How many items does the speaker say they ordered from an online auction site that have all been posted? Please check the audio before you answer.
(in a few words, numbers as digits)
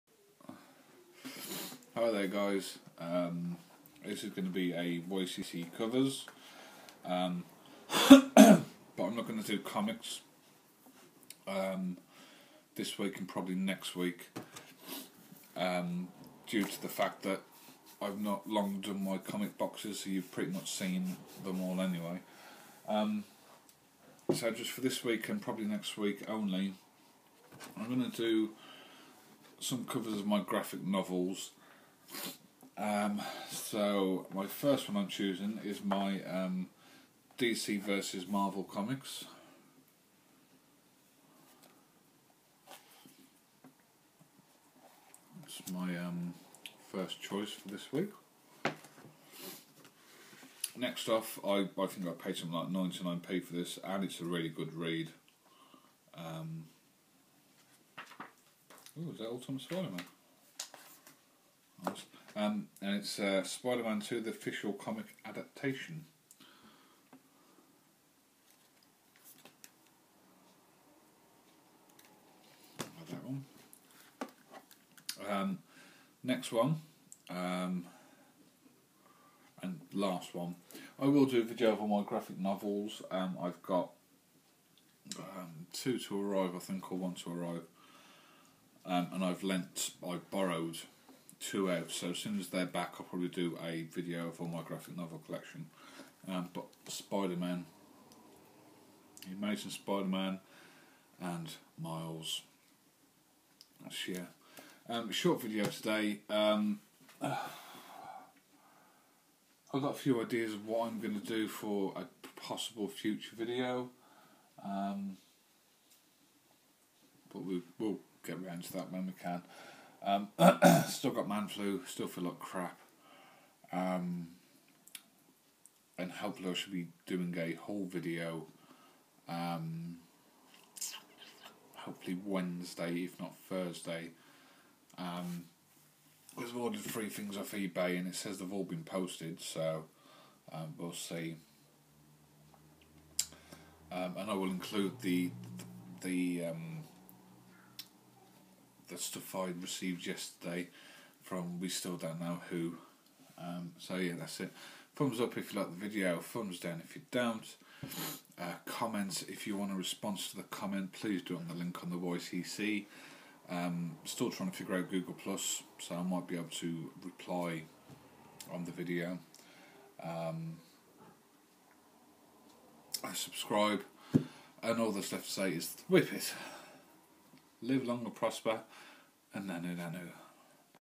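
3.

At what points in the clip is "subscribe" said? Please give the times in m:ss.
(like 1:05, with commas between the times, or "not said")
2:53.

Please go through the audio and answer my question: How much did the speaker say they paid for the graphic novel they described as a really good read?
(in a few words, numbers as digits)
99p.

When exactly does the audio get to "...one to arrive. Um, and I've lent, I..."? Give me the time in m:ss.
1:26.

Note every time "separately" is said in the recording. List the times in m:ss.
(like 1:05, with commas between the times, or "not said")
not said.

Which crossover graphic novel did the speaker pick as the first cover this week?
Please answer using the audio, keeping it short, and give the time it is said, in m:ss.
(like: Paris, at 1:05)
DC versus Marvel, at 0:37.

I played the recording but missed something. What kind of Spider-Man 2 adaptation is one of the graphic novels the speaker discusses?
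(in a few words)
official comic adaptation.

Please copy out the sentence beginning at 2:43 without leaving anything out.
Um, still trying to figure out Google Plus, so I might be able to reply on the video.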